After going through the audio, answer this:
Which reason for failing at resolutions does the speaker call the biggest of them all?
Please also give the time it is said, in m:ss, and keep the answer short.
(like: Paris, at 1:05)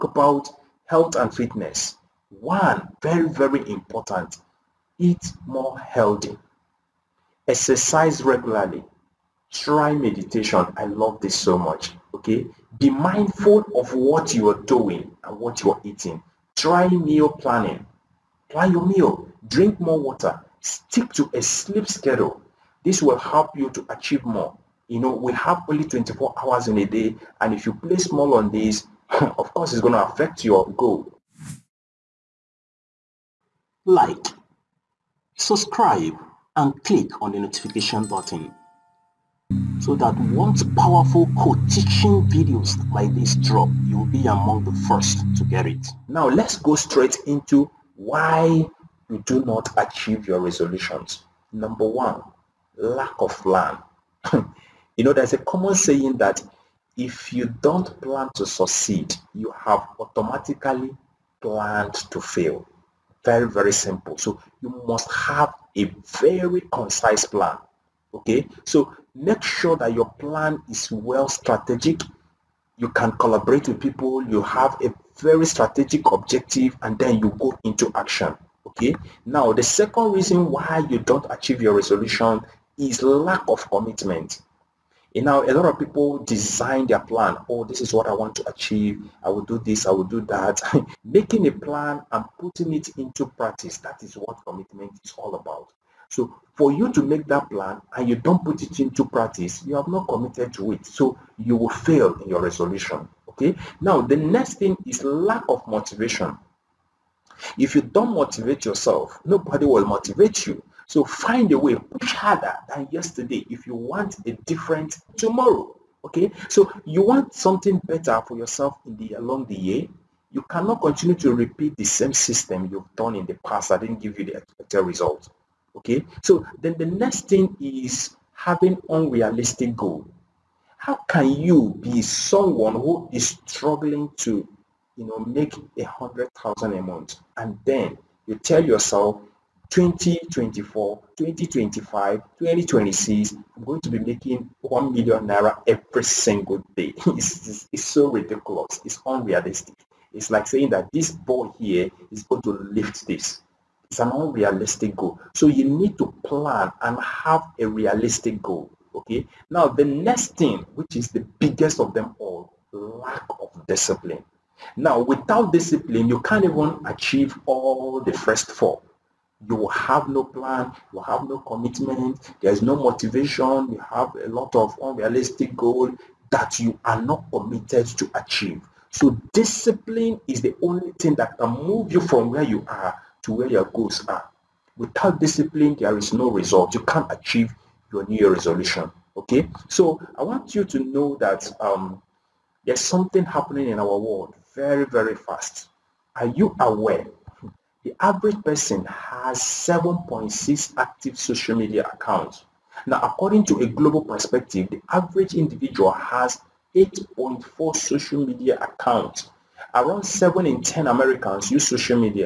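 lack of discipline, at 2:42.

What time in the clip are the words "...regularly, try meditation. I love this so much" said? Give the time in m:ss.
0:08.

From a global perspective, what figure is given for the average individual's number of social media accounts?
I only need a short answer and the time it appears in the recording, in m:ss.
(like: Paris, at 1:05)
8.4, at 3:26.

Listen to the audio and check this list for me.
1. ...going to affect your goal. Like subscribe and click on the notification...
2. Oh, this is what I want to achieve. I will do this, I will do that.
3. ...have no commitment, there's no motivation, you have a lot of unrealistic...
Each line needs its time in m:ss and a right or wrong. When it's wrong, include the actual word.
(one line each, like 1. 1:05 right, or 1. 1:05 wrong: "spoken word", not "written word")
1. 0:29 right
2. 1:27 right
3. 2:50 right.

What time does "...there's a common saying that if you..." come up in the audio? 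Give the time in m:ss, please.
0:55.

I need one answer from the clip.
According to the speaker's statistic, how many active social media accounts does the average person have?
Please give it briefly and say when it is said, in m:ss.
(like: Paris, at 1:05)
7.6, at 3:19.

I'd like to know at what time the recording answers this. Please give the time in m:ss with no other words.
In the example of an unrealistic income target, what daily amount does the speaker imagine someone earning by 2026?
2:24.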